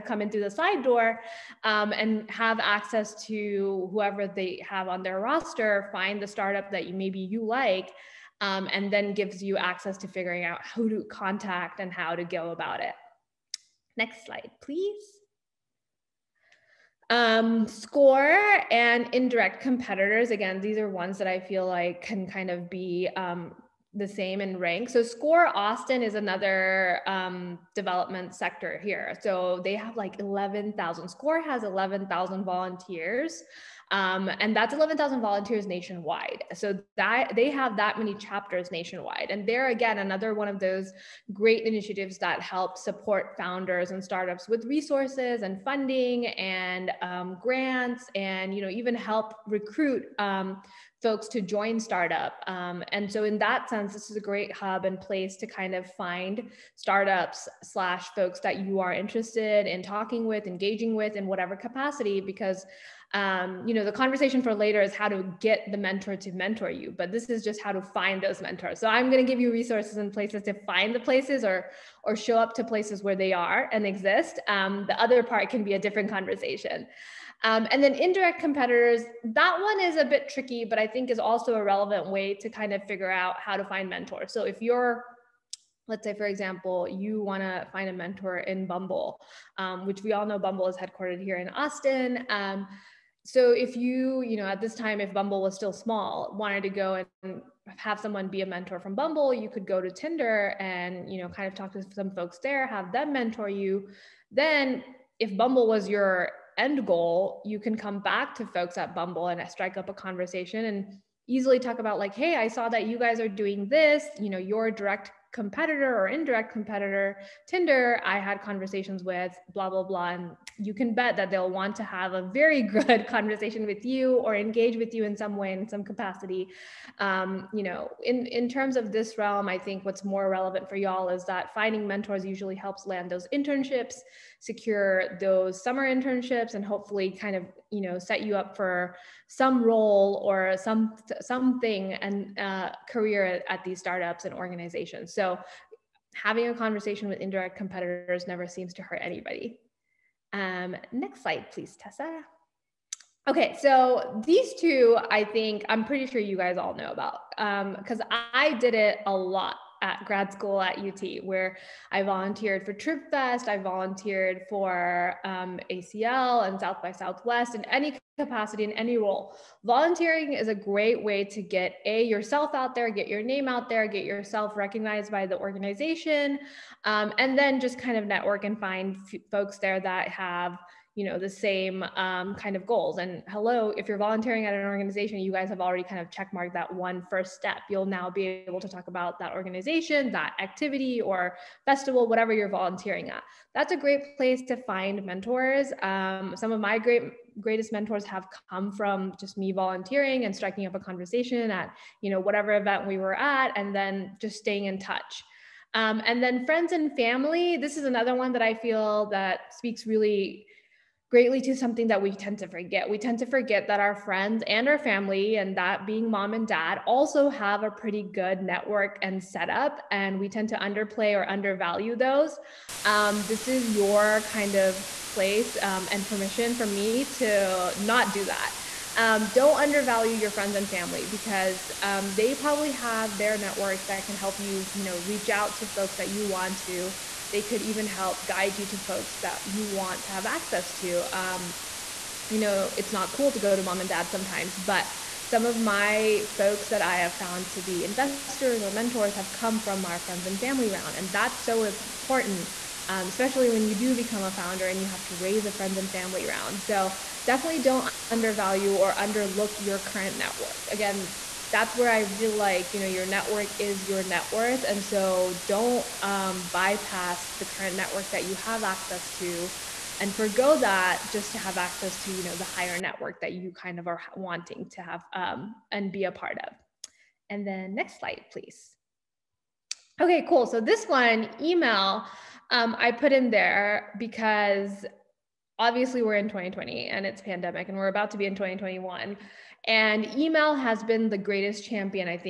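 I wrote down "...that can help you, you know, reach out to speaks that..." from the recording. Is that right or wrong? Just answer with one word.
wrong.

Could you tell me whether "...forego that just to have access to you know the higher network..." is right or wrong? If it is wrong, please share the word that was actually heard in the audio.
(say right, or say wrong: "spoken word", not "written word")
right.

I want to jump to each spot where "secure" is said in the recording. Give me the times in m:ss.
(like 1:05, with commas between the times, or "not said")
2:14.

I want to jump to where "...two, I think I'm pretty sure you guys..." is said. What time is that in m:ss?
2:34.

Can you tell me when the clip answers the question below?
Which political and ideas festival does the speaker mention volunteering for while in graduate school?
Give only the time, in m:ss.
2:42.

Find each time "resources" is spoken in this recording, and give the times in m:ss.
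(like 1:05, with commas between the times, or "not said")
0:44, 1:09.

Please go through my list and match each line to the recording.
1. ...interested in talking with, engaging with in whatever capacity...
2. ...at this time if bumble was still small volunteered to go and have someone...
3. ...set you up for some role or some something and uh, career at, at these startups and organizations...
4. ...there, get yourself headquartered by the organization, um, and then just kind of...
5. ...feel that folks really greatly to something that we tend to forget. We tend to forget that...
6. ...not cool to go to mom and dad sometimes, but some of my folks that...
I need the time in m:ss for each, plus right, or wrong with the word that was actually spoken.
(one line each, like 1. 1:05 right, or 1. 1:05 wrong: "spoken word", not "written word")
1. 0:58 right
2. 1:34 wrong: "wanted", not "volunteered"
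3. 2:17 right
4. 2:53 wrong: "recognized", not "headquartered"
5. 3:28 wrong: "speaks", not "folks"
6. 4:02 right.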